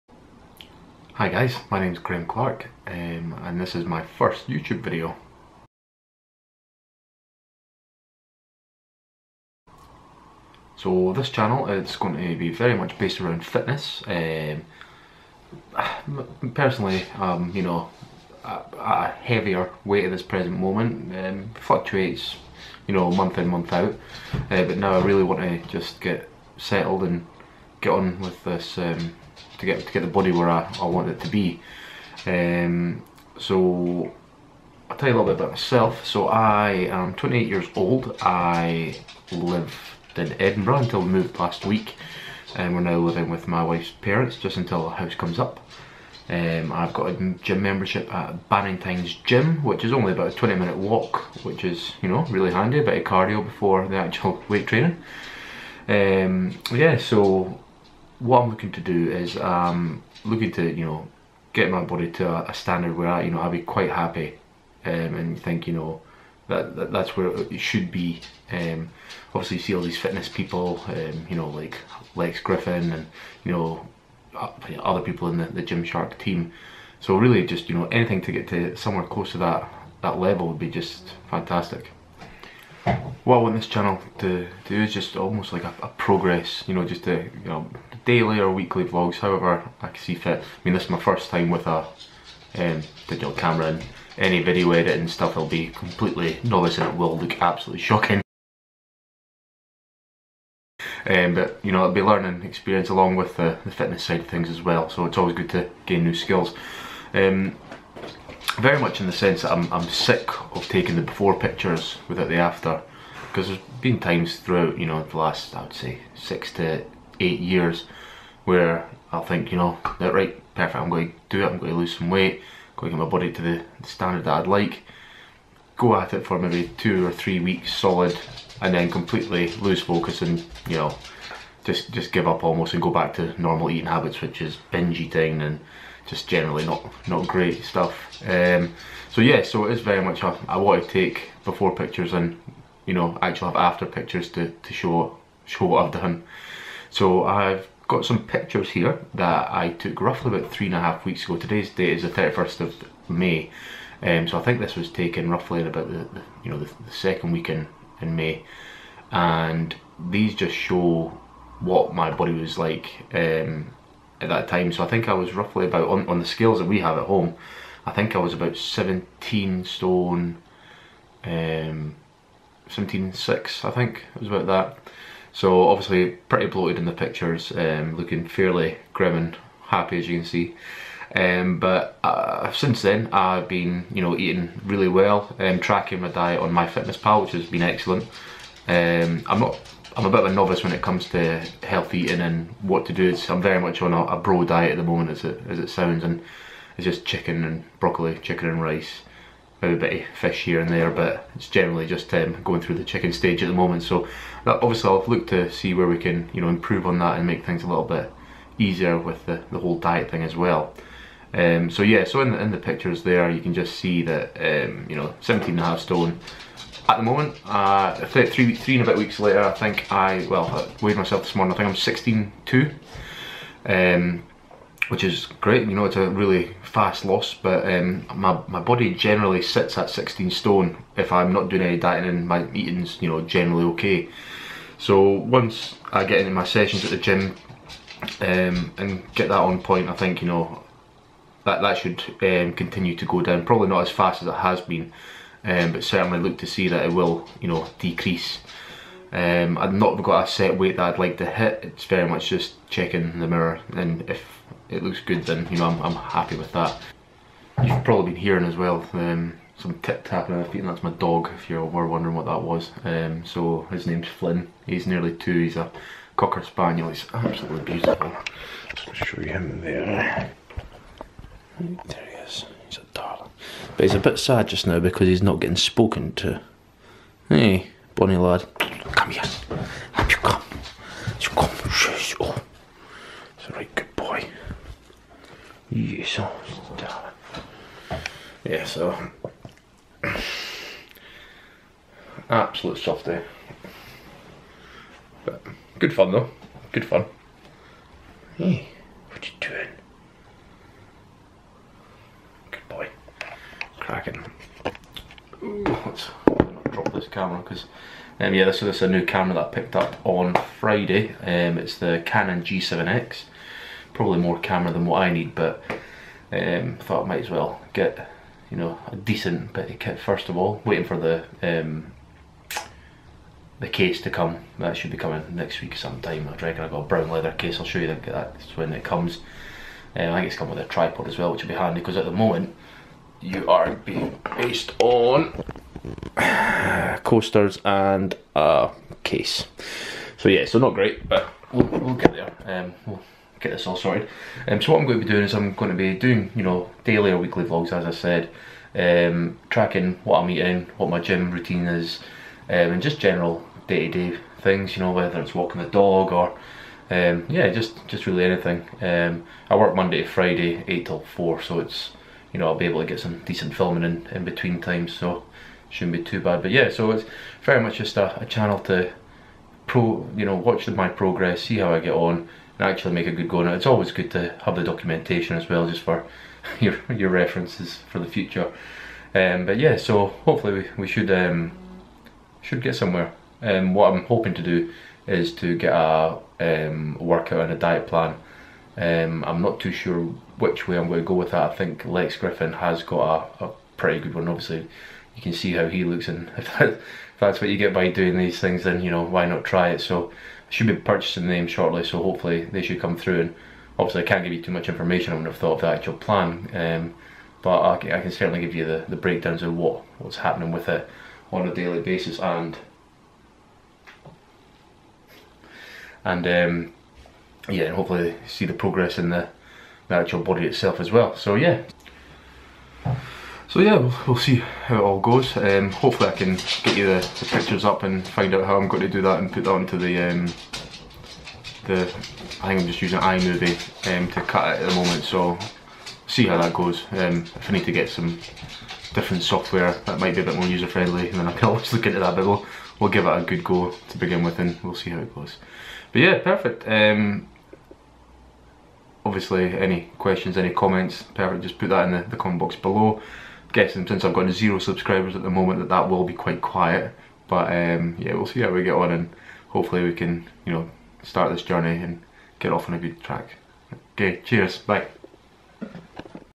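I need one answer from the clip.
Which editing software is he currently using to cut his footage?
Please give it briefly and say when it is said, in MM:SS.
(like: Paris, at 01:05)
iMovie, at 07:13.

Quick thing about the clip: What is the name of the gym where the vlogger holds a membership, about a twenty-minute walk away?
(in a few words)
Bannington's Gym.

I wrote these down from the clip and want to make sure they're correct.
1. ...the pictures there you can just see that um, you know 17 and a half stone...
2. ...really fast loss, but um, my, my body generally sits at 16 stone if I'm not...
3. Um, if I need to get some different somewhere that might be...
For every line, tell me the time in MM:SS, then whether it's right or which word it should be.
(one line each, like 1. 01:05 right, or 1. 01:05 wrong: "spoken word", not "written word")
1. 03:32 right
2. 03:46 right
3. 07:16 wrong: "software", not "somewhere".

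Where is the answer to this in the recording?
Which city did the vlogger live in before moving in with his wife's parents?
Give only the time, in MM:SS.
00:40.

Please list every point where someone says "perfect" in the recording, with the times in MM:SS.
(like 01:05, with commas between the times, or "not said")
02:00, 07:26, 07:31.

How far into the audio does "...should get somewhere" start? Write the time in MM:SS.
06:22.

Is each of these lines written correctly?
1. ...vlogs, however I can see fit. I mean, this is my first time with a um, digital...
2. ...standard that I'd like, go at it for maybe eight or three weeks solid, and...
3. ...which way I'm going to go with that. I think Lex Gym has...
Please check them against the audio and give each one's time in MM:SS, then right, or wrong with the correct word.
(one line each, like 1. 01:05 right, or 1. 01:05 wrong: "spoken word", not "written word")
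1. 01:28 right
2. 02:03 wrong: "two", not "eight"
3. 06:30 wrong: "Griffin", not "Gym".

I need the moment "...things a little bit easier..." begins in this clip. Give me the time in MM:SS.
03:27.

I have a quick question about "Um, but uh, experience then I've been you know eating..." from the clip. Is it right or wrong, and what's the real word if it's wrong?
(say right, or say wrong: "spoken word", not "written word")
wrong: "since", not "experience".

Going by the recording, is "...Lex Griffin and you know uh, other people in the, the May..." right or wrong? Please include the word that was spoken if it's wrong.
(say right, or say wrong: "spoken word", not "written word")
wrong: "Gymshark", not "May".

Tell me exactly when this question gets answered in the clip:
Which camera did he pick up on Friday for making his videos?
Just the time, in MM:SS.
05:12.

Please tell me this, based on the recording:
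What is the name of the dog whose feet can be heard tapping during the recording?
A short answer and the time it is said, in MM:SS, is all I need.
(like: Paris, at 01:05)
Flynn, at 04:24.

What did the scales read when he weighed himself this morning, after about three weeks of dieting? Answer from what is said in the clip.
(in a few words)
16.2.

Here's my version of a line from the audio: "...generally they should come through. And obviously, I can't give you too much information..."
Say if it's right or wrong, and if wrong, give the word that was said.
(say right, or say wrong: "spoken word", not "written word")
wrong: "hopefully", not "generally".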